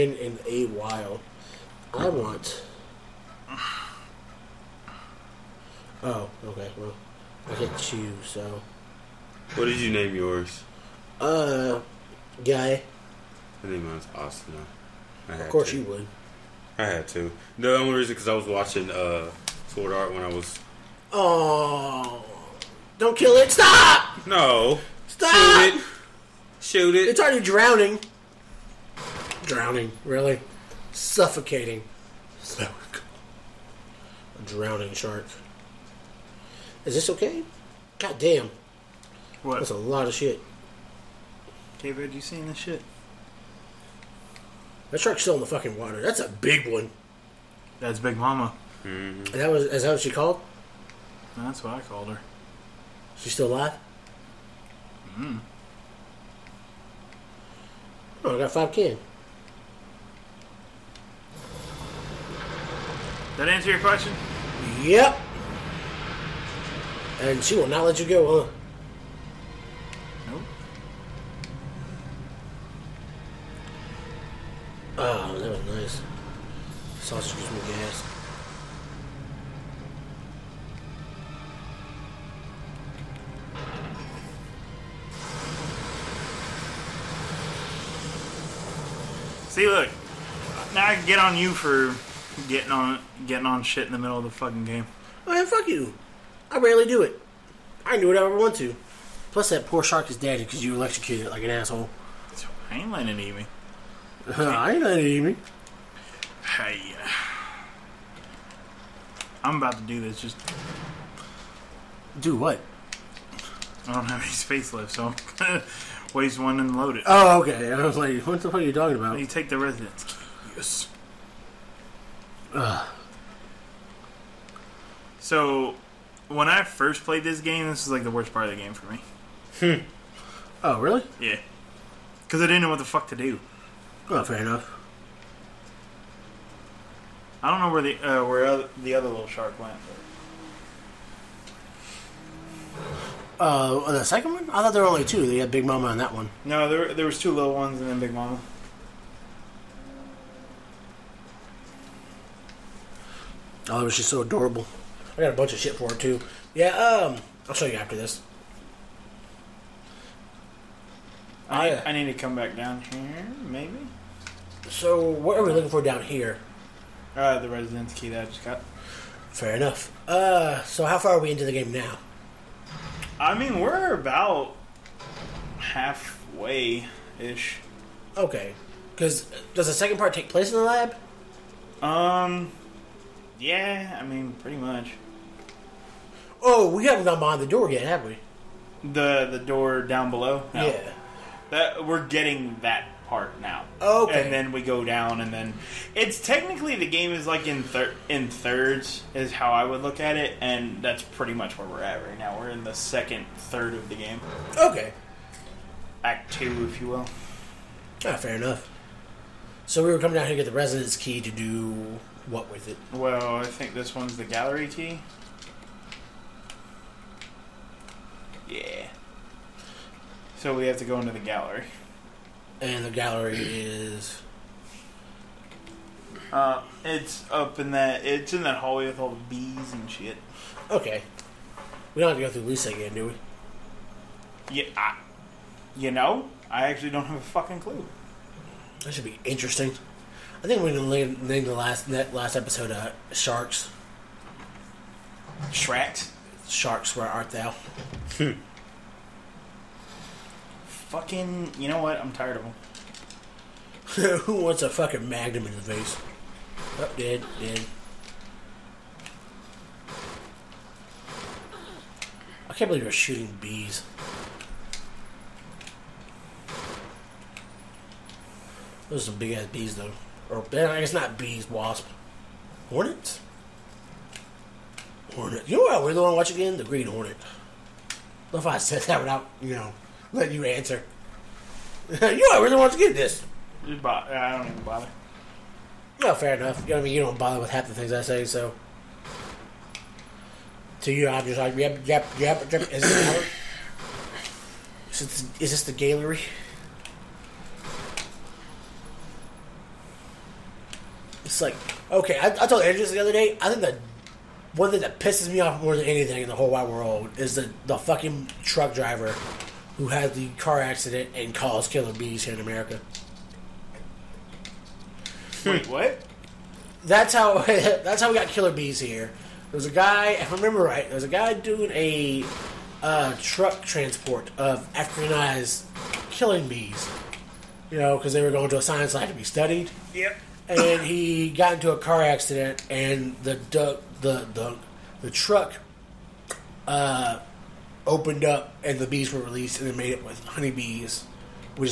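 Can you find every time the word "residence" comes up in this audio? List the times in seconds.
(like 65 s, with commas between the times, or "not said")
119 s, 167 s, 210 s.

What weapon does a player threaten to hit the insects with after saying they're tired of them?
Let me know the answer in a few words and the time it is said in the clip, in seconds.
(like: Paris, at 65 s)
magnum, at 255 s.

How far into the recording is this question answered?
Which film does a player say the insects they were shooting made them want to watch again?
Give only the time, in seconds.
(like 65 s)
276 s.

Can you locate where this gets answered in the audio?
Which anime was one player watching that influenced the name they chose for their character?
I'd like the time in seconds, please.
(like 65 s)
19 s.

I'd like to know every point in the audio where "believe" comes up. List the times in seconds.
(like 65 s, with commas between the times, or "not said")
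262 s.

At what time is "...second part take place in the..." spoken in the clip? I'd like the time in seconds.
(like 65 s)
179 s.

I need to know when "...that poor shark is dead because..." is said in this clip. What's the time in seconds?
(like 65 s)
99 s.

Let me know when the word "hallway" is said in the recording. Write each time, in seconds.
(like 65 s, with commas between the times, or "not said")
228 s.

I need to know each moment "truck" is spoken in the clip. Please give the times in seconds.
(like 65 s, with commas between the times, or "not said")
308 s, 323 s, 335 s.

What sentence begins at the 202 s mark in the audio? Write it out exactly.
We're in the second third of the game.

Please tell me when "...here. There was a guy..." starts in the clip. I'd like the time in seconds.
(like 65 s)
318 s.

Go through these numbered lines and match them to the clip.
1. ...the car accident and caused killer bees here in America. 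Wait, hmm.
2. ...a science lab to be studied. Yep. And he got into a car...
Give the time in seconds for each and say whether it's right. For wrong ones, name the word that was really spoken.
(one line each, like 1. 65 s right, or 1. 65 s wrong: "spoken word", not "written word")
1. 310 s right
2. 328 s right.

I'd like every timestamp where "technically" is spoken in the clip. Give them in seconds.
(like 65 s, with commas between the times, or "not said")
196 s.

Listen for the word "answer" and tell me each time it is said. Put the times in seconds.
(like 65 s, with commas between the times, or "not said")
63 s, 280 s.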